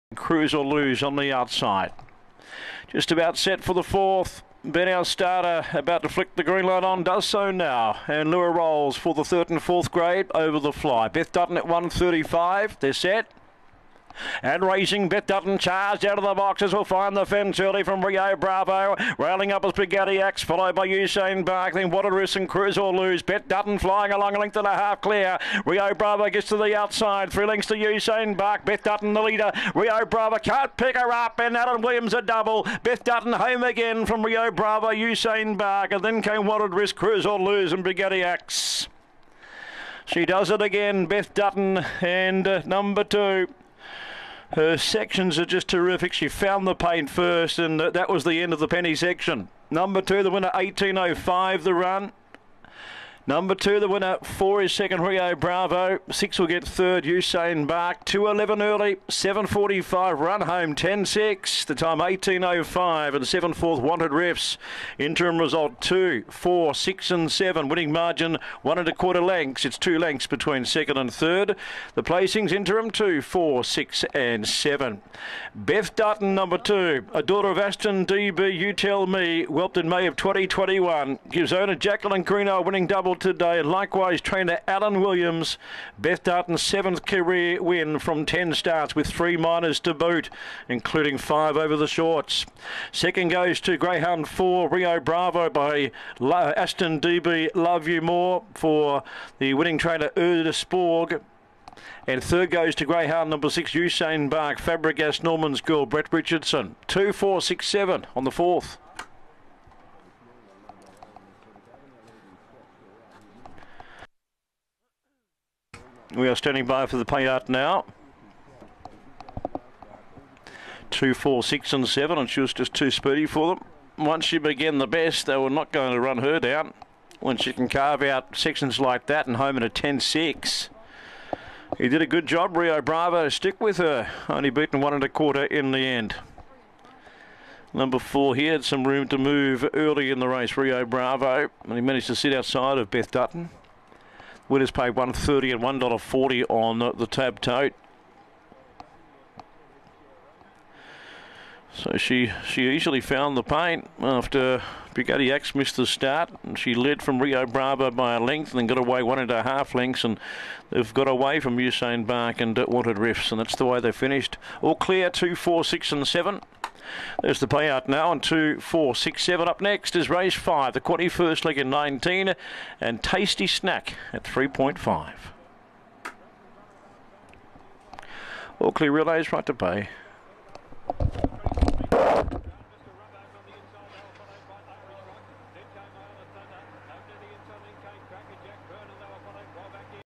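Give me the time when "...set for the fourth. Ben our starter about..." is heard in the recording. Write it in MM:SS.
00:03.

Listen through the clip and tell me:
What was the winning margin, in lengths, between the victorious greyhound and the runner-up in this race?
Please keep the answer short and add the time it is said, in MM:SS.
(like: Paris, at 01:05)
1 and a quarter lengths, at 01:08.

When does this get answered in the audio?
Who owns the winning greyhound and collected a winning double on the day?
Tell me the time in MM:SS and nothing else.
01:21.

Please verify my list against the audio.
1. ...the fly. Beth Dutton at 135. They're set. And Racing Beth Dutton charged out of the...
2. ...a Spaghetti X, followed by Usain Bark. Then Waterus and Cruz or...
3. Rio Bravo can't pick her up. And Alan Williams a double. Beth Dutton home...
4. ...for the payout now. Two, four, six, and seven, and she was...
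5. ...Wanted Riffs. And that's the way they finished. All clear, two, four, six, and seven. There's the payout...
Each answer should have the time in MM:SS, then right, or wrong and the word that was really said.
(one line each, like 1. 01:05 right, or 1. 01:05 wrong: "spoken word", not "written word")
1. 00:10 right
2. 00:19 right
3. 00:29 right
4. 01:56 right
5. 02:42 right.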